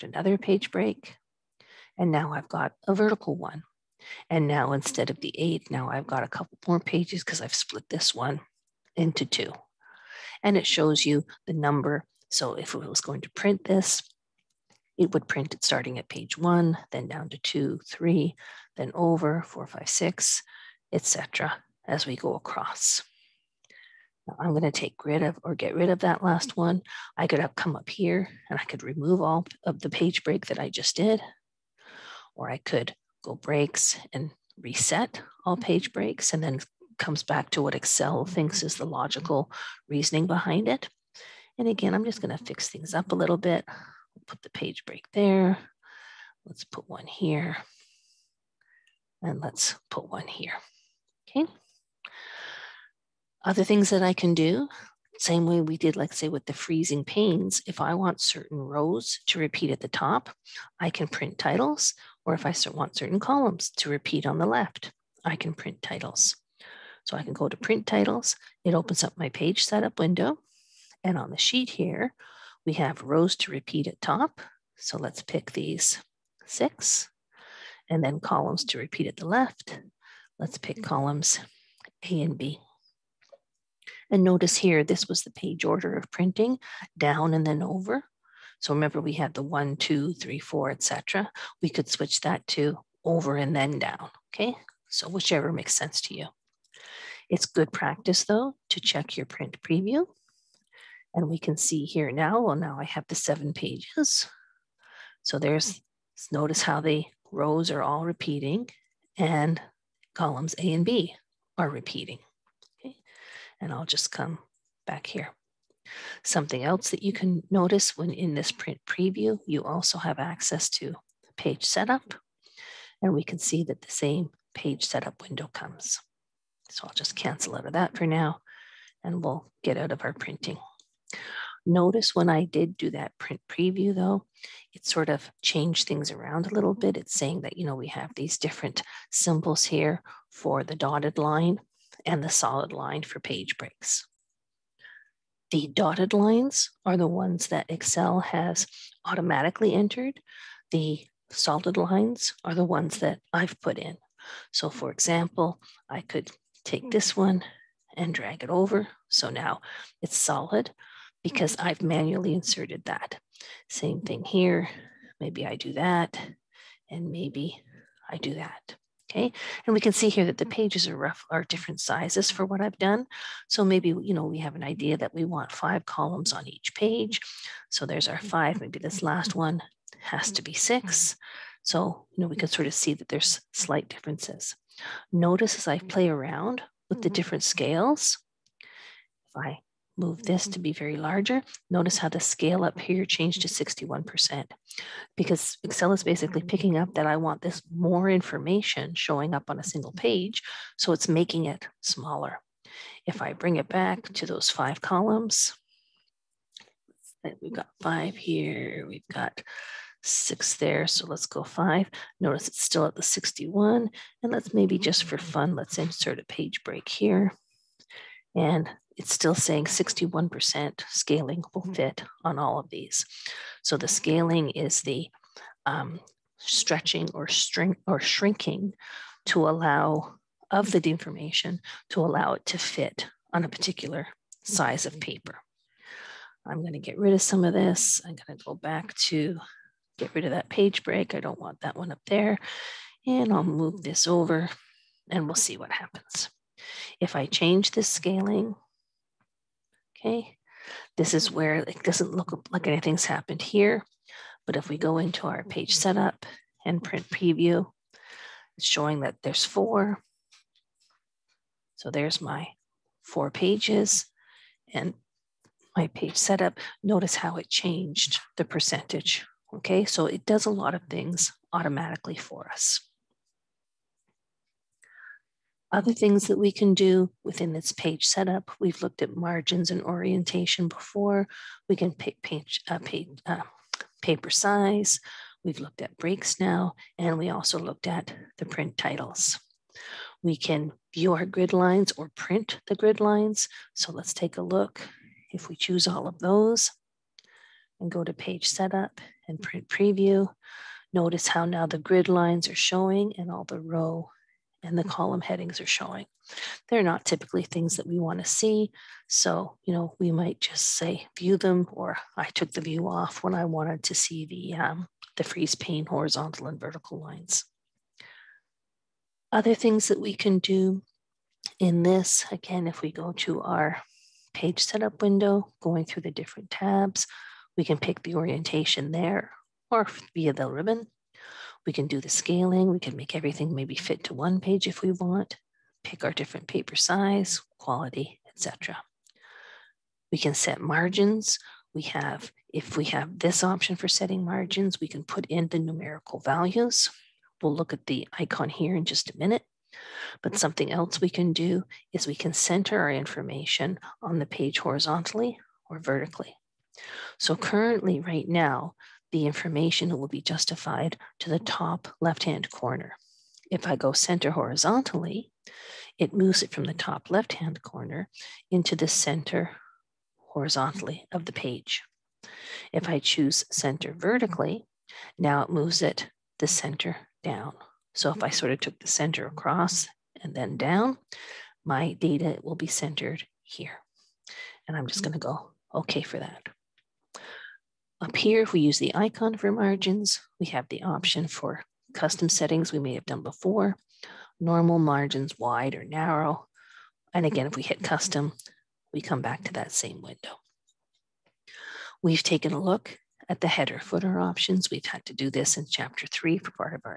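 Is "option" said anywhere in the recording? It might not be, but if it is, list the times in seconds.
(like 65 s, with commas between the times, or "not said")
343 s, 390 s, 404 s.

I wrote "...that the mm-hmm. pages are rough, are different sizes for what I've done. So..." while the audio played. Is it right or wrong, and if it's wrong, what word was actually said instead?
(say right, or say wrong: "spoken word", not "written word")
right.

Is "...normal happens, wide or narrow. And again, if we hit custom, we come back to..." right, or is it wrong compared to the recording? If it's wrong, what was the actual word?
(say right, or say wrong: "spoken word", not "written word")
wrong: "margins", not "happens".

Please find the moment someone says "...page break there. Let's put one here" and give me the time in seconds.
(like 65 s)
44 s.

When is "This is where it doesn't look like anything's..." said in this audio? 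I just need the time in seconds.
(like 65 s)
250 s.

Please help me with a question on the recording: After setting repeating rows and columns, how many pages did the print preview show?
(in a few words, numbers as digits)
7.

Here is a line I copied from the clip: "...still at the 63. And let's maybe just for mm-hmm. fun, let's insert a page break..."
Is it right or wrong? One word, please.
wrong.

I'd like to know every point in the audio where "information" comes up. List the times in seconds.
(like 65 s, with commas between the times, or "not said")
198 s, 352 s, 359 s.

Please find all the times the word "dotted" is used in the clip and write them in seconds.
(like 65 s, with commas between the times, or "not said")
140 s, 145 s.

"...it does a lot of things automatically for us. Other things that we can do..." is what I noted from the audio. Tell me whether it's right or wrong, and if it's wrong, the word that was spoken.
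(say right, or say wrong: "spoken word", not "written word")
right.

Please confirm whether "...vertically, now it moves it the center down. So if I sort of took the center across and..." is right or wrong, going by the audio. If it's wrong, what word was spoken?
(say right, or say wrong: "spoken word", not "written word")
right.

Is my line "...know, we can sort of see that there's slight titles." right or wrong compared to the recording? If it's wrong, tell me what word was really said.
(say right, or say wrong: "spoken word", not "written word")
wrong: "differences", not "titles".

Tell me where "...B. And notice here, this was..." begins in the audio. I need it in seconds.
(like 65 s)
82 s.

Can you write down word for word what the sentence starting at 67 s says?
So I can go to print titles.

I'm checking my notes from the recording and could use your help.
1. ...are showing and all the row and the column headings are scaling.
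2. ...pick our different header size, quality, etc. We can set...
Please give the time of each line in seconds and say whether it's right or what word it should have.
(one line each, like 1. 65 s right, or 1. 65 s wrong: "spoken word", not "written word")
1. 302 s wrong: "showing", not "scaling"
2. 335 s wrong: "paper", not "header".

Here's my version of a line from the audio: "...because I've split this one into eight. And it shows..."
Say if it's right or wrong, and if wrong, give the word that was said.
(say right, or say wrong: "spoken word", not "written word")
wrong: "two", not "eight".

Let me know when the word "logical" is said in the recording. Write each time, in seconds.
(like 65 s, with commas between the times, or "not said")
38 s.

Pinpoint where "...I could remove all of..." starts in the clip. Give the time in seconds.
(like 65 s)
28 s.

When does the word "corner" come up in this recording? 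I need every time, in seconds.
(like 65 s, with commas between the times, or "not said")
362 s, 367 s.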